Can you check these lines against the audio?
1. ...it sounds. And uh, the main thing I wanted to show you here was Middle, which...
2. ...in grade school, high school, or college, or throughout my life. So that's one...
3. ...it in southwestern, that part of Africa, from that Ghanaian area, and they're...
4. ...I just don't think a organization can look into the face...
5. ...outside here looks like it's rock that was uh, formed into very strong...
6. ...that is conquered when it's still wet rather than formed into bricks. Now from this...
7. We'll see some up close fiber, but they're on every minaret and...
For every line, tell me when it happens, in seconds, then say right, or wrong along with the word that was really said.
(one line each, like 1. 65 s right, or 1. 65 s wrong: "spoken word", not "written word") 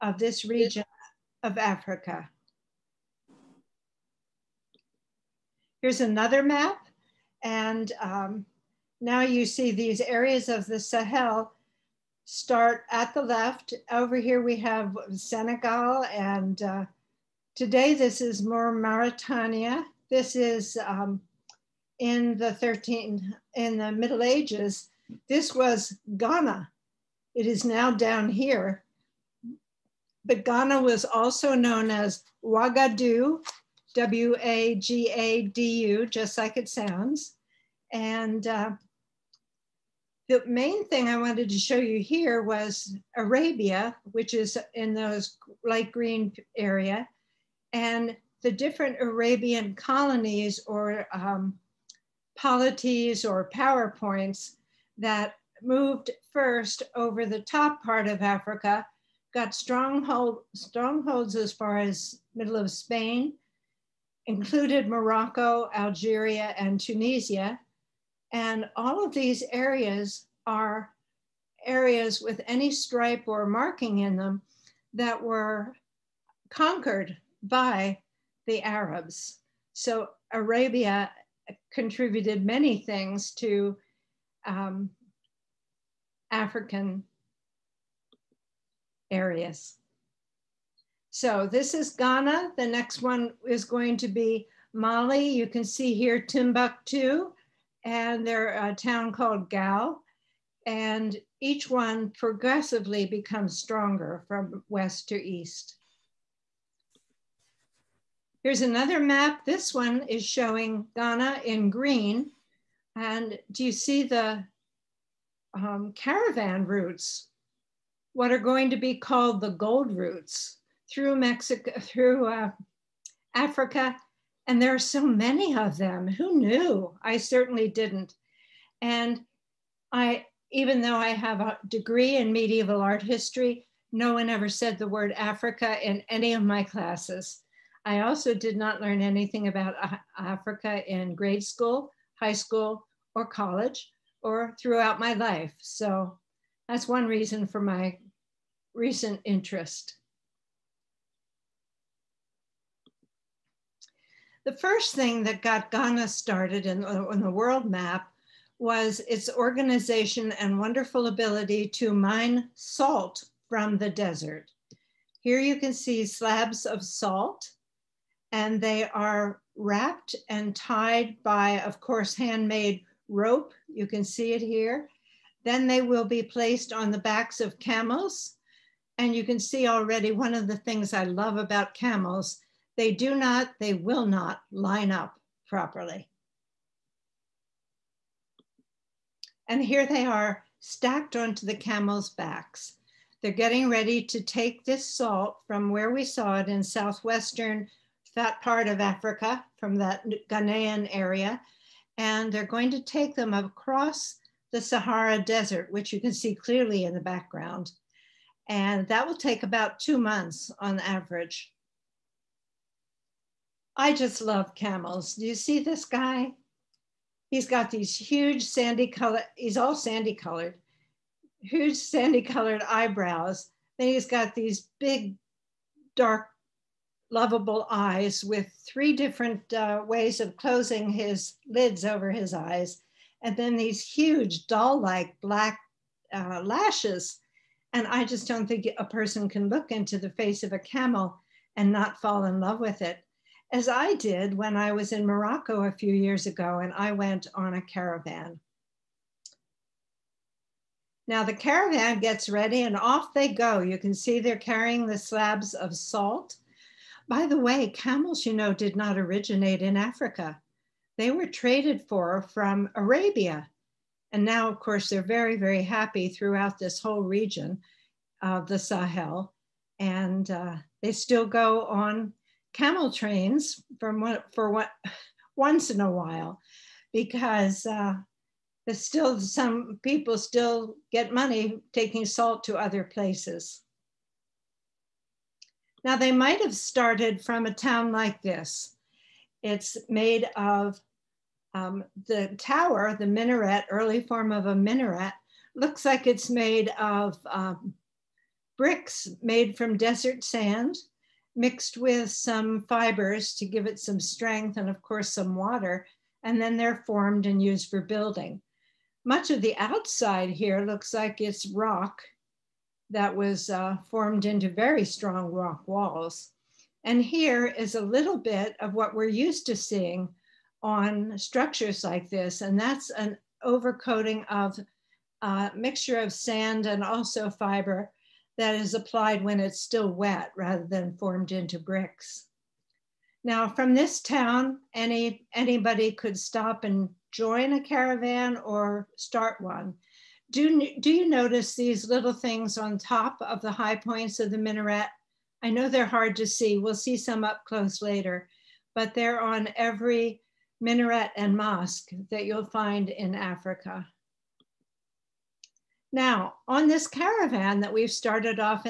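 1. 36 s wrong: "Arabia", not "Middle"
2. 140 s right
3. 196 s right
4. 237 s wrong: "person", not "organization"
5. 309 s right
6. 328 s wrong: "applied", not "conquered"
7. 346 s wrong: "later", not "fiber".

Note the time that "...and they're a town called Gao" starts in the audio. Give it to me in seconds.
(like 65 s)
97 s.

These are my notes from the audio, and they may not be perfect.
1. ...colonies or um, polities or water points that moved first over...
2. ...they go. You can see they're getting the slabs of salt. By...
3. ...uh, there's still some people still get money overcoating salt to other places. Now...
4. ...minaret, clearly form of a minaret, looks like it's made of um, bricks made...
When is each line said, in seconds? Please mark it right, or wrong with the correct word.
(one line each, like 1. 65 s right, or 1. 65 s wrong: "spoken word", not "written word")
1. 49 s wrong: "power", not "water"
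2. 253 s wrong: "carrying", not "getting"
3. 277 s wrong: "taking", not "overcoating"
4. 293 s wrong: "early", not "clearly".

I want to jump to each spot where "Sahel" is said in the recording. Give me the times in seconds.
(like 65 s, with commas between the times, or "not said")
10 s, 268 s.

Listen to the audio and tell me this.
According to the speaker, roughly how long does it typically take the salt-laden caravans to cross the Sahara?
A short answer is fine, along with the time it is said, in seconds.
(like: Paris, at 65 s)
About two months, at 209 s.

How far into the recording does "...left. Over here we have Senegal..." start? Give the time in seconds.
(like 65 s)
13 s.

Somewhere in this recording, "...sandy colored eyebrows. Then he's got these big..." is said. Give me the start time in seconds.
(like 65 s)
221 s.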